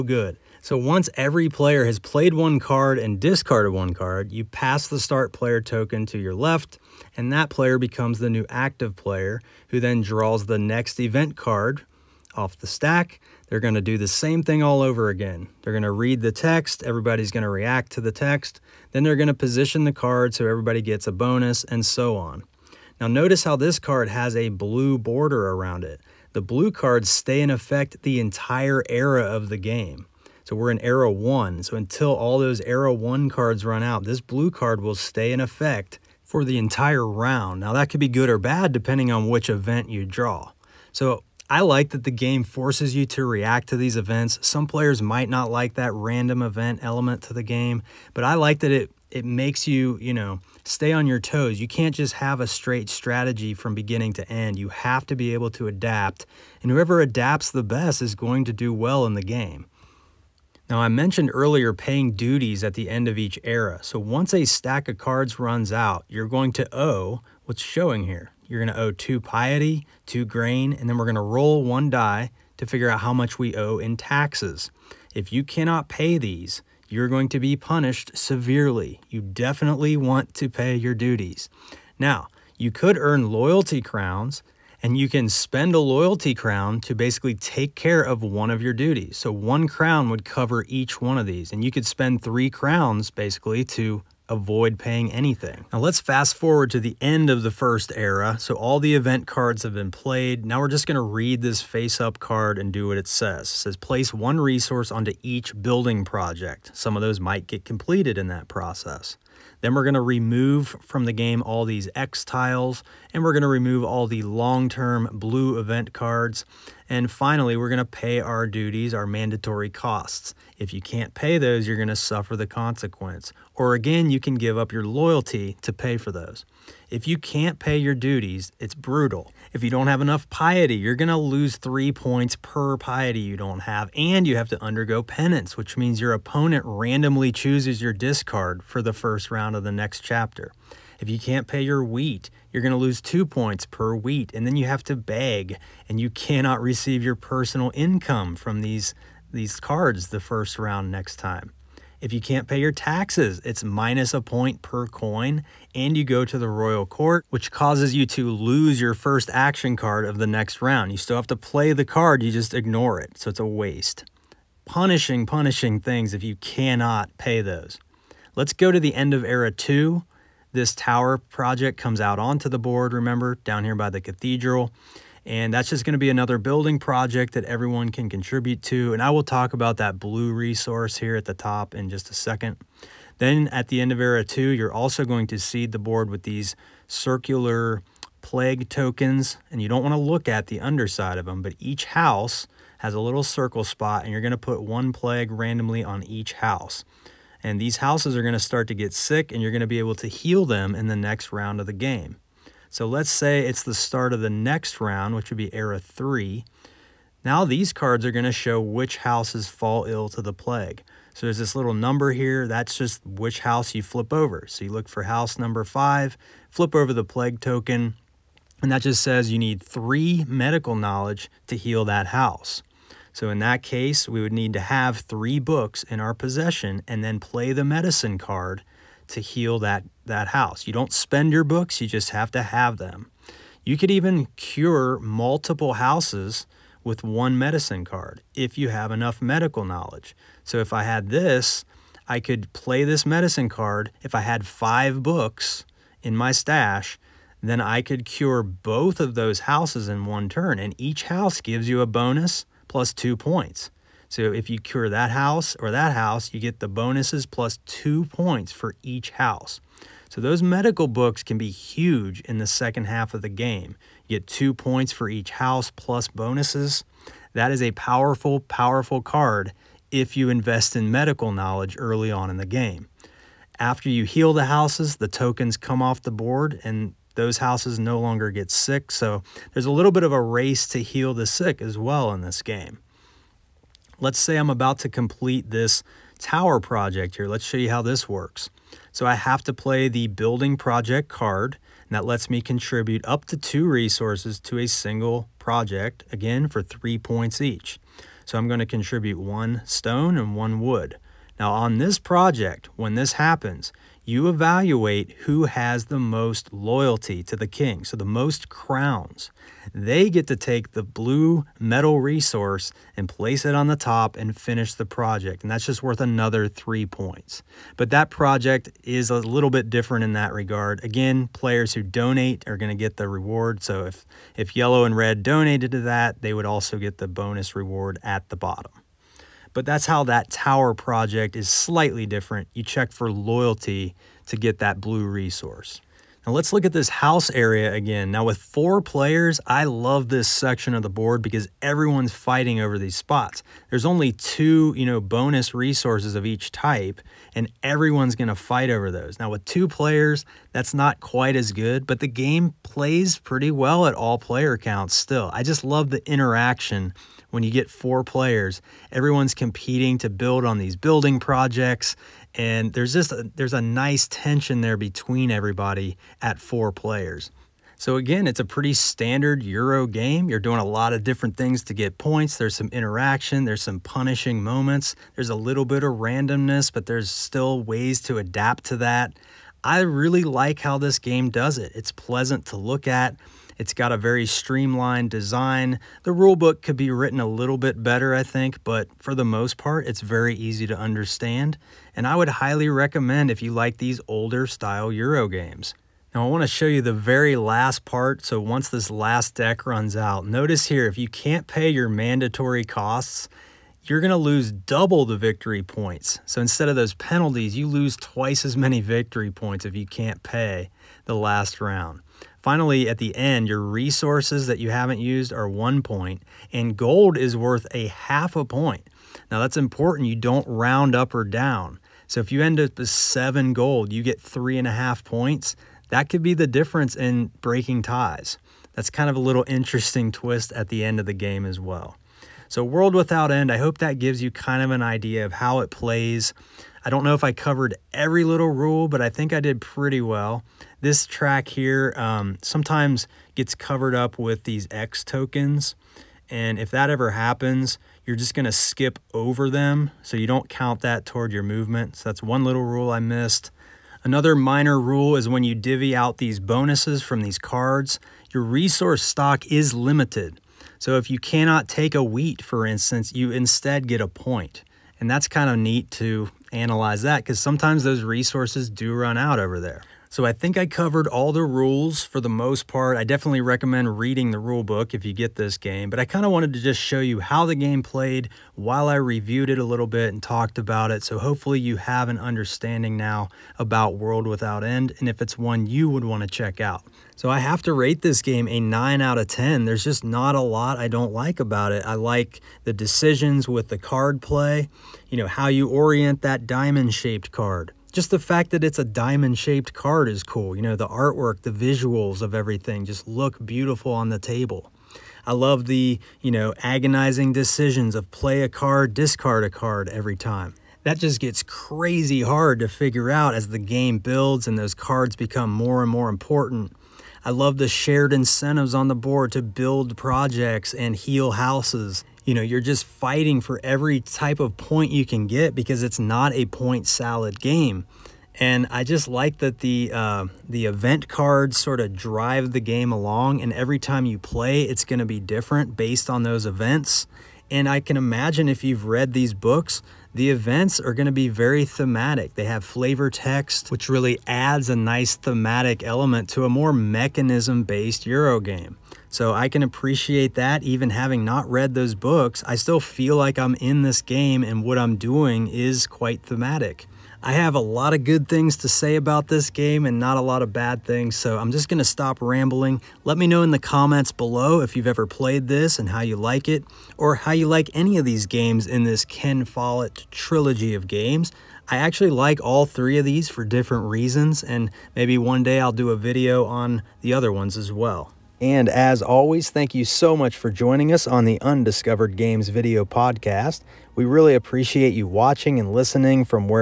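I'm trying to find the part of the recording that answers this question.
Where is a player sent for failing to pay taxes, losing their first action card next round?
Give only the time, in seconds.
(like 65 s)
156 s.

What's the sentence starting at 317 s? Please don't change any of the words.
But that project is a little bit different in that regard.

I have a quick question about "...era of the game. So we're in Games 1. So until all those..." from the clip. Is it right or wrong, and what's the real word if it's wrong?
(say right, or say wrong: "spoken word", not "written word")
wrong: "Era", not "Games".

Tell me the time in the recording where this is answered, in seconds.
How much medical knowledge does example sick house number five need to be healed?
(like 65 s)
219 s.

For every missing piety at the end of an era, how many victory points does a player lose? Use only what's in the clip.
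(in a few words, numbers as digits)
3.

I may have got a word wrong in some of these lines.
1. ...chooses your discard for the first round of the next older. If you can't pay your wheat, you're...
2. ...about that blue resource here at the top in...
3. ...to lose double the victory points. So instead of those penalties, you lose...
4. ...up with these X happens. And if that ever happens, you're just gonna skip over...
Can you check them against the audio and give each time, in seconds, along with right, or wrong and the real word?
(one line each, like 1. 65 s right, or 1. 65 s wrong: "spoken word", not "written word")
1. 137 s wrong: "chapter", not "older"
2. 179 s right
3. 404 s right
4. 443 s wrong: "tokens", not "happens".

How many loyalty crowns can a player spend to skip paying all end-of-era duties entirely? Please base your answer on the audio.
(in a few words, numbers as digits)
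3.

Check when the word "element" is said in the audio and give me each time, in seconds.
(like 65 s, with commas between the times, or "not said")
46 s, 545 s.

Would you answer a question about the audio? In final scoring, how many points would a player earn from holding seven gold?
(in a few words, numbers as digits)
3.5.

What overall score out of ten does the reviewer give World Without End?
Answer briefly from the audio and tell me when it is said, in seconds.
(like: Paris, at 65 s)
9, at 488 s.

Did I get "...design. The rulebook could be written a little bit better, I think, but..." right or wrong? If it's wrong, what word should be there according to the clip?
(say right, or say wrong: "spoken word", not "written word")
right.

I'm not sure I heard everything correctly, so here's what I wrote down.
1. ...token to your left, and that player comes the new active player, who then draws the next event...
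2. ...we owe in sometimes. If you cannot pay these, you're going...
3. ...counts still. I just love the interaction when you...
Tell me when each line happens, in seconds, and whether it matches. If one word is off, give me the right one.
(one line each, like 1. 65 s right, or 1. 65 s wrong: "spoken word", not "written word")
1. 5 s wrong: "becomes", not "comes"
2. 73 s wrong: "taxes", not "sometimes"
3. 354 s right.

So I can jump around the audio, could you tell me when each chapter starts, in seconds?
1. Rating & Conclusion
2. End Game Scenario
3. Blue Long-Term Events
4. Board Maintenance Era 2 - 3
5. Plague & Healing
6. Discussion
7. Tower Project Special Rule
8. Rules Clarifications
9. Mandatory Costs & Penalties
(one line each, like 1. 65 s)
1. 474 s
2. 395 s
3. 22 s
4. 167 s
5. 202 s
6. 335 s
7. 283 s
8. 431 s
9. 60 s.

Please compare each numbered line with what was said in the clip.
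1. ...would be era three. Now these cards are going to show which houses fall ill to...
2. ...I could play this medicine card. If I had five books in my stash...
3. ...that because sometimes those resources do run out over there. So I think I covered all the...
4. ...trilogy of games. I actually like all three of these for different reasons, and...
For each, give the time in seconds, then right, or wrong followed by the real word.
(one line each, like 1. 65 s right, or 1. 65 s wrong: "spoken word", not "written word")
1. 205 s right
2. 242 s right
3. 467 s right
4. 570 s right.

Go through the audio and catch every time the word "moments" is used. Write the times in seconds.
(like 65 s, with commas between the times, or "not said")
374 s.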